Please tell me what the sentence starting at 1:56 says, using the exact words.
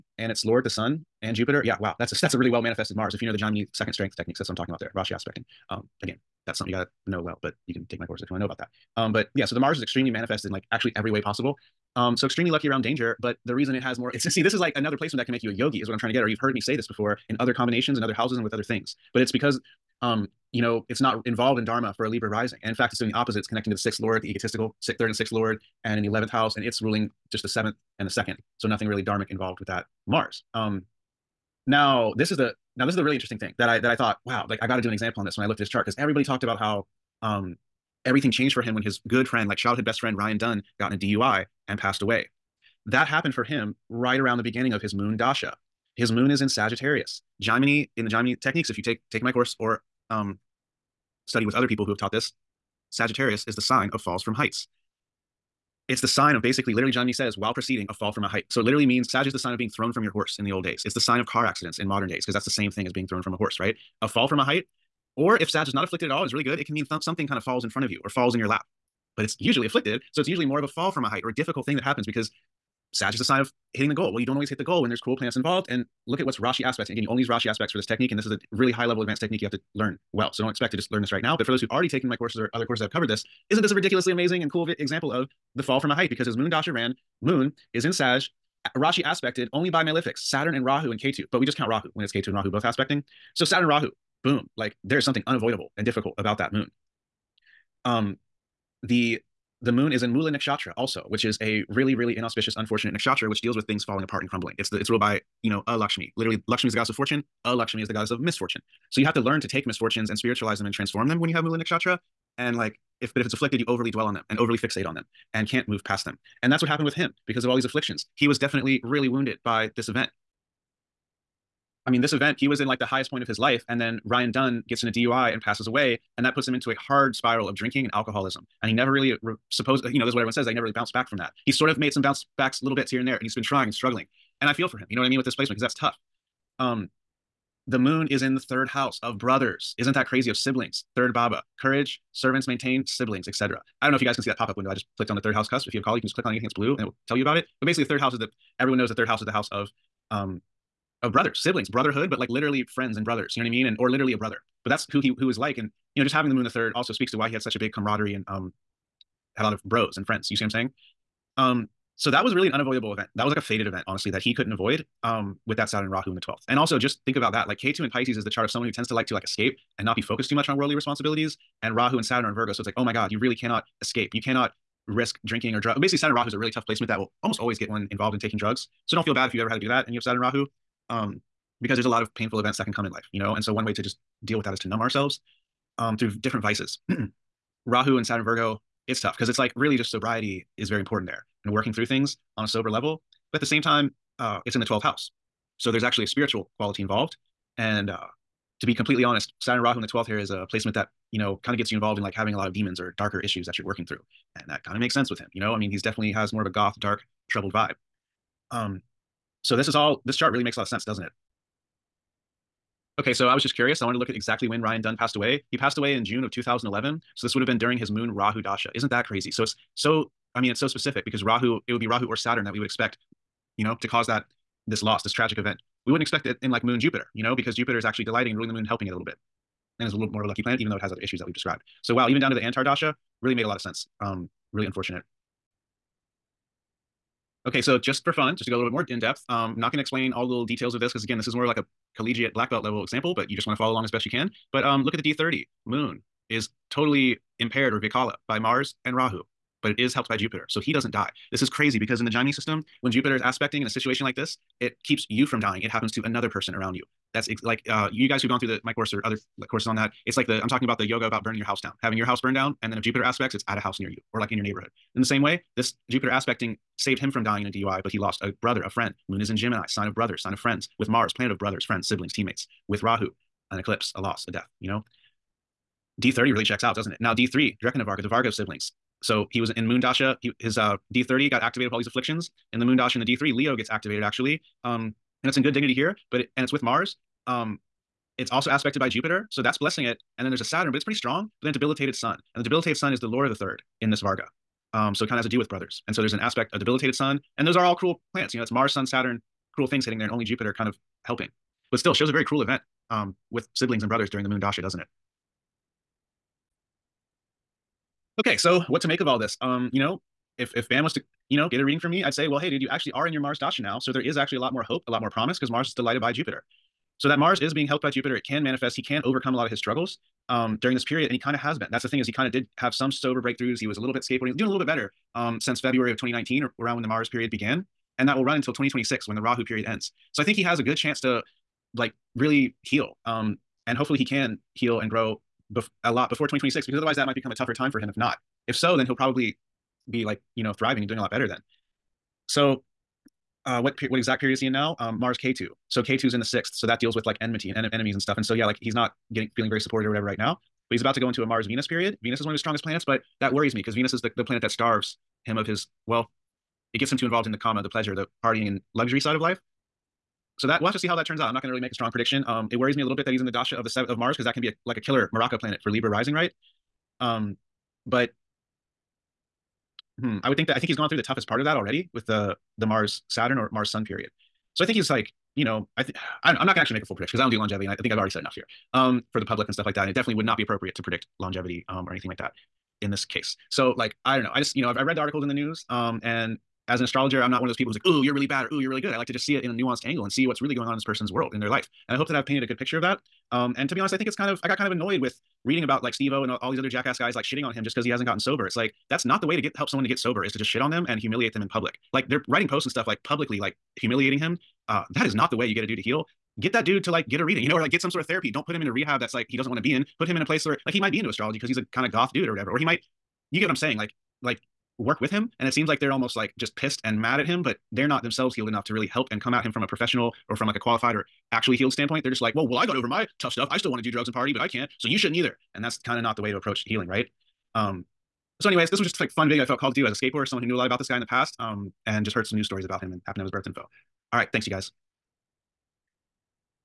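And that's what happened with him because of all these afflictions.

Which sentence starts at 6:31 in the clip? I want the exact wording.
And I hope that I've painted a good picture of that.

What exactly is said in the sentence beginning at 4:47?
Um, it's also aspected by Jupiter, so that's blessing it.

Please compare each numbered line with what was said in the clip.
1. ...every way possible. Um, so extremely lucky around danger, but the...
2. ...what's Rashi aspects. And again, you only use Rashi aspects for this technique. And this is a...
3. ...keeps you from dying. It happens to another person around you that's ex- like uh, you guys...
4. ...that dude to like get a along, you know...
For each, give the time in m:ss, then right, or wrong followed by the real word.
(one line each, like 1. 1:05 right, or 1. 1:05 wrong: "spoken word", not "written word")
1. 0:10 right
2. 1:16 right
3. 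4:14 right
4. 6:46 wrong: "reading", not "along".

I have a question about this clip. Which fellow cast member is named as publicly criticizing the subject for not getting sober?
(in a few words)
Steve-O.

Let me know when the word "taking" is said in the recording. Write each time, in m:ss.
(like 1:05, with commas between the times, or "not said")
0:49, 2:58.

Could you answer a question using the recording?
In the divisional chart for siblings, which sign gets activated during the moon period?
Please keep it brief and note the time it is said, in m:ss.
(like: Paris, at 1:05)
Leo, at 4:43.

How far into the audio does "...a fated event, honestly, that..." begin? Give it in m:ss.
2:43.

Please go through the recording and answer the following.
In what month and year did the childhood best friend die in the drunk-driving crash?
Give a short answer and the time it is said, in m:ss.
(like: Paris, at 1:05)
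June 2011, at 3:36.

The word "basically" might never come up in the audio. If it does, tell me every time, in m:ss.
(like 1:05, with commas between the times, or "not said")
0:56, 2:27, 2:55.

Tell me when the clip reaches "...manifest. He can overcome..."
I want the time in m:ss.
5:18.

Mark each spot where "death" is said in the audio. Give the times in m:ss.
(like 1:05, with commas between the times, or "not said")
4:34.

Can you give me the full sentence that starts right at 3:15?
So there's actually a spiritual quality involved.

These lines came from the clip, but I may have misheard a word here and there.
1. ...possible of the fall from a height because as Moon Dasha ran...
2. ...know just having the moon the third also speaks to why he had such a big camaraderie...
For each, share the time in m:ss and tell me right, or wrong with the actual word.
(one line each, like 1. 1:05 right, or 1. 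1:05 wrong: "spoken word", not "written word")
1. 1:24 wrong: "example", not "possible"
2. 2:36 right.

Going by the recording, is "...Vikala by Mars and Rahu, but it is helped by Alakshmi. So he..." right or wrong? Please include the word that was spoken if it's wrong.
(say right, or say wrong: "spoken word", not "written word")
wrong: "Jupiter", not "Alakshmi".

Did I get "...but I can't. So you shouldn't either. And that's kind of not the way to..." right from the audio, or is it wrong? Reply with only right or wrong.
right.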